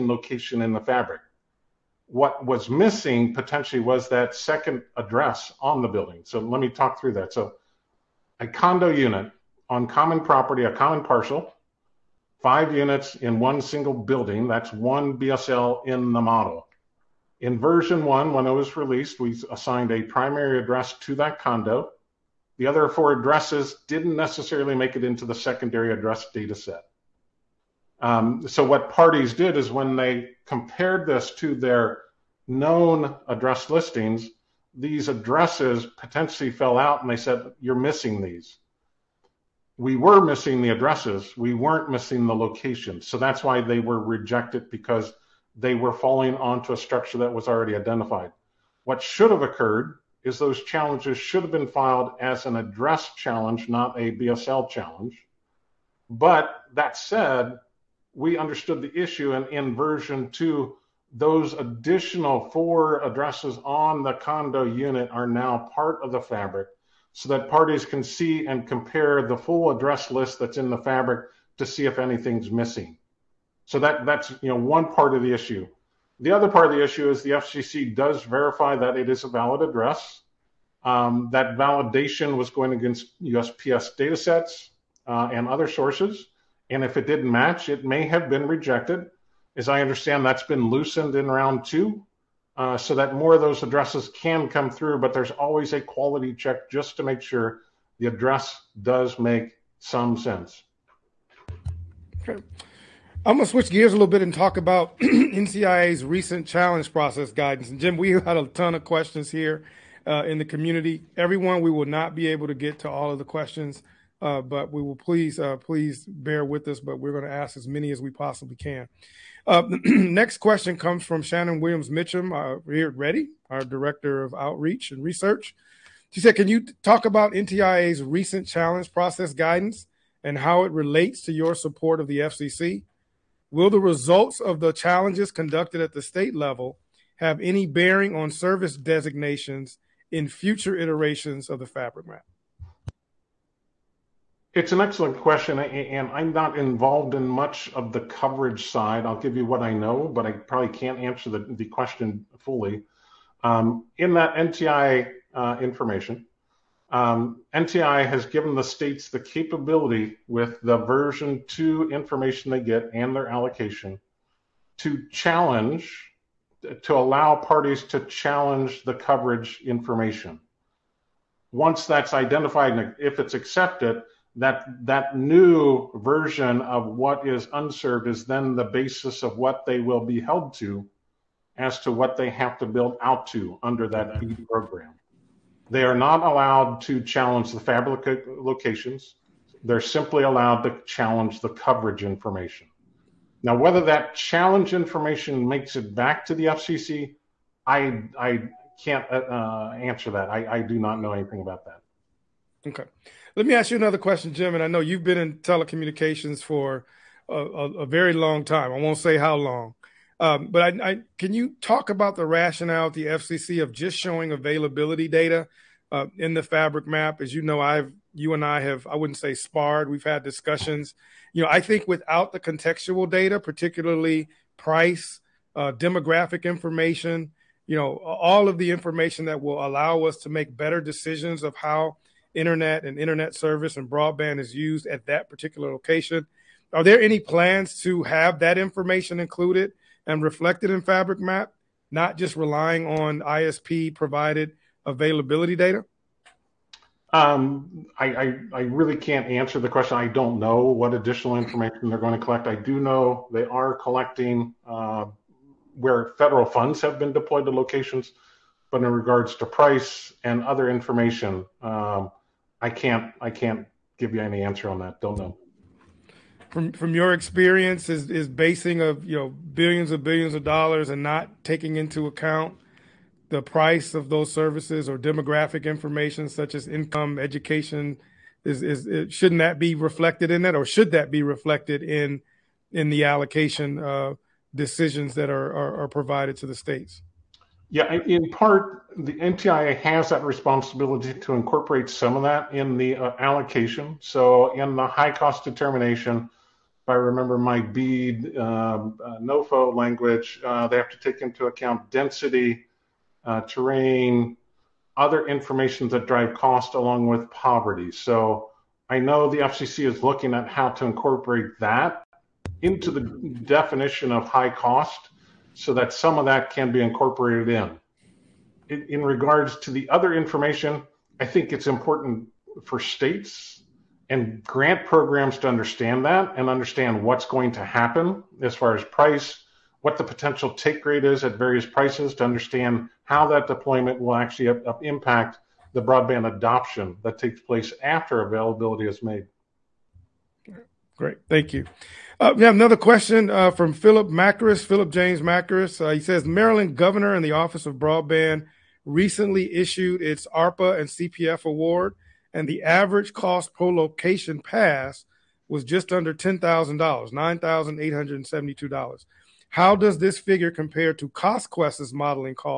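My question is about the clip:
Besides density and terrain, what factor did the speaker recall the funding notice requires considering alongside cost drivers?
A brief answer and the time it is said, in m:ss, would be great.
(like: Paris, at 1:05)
Poverty, at 5:07.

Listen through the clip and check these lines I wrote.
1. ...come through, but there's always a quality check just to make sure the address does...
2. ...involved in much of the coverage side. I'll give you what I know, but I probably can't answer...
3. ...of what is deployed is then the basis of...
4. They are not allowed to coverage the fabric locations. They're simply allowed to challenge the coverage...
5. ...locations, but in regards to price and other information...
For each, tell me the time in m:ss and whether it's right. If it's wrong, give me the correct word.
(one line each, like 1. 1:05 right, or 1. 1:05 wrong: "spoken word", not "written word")
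1. 1:34 right
2. 2:26 right
3. 2:56 wrong: "unserved", not "deployed"
4. 3:05 wrong: "challenge", not "coverage"
5. 4:17 right.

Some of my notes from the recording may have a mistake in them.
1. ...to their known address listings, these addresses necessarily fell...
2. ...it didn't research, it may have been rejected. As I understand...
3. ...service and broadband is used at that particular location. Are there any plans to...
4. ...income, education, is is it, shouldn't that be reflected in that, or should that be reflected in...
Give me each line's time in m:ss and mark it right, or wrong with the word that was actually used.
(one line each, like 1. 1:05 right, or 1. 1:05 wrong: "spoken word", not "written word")
1. 0:31 wrong: "potentially", not "necessarily"
2. 1:26 wrong: "match", not "research"
3. 3:53 right
4. 4:36 right.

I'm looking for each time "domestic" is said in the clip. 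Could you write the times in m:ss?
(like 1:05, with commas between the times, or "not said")
not said.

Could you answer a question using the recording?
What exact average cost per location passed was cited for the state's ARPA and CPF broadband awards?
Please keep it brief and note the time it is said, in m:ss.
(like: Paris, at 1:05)
$9,872, at 5:57.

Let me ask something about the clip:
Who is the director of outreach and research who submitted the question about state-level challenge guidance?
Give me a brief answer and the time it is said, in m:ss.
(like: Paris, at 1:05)
Shannon Williams Mitchum, at 2:01.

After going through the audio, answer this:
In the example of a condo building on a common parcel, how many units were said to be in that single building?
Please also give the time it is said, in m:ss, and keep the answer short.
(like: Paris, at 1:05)
5, at 0:12.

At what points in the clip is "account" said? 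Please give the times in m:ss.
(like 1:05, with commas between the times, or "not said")
4:32, 5:01.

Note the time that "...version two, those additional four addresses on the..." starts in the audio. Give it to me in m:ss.
0:59.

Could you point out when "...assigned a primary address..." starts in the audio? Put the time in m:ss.
0:19.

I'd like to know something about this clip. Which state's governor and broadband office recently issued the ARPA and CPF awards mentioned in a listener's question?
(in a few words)
Maryland.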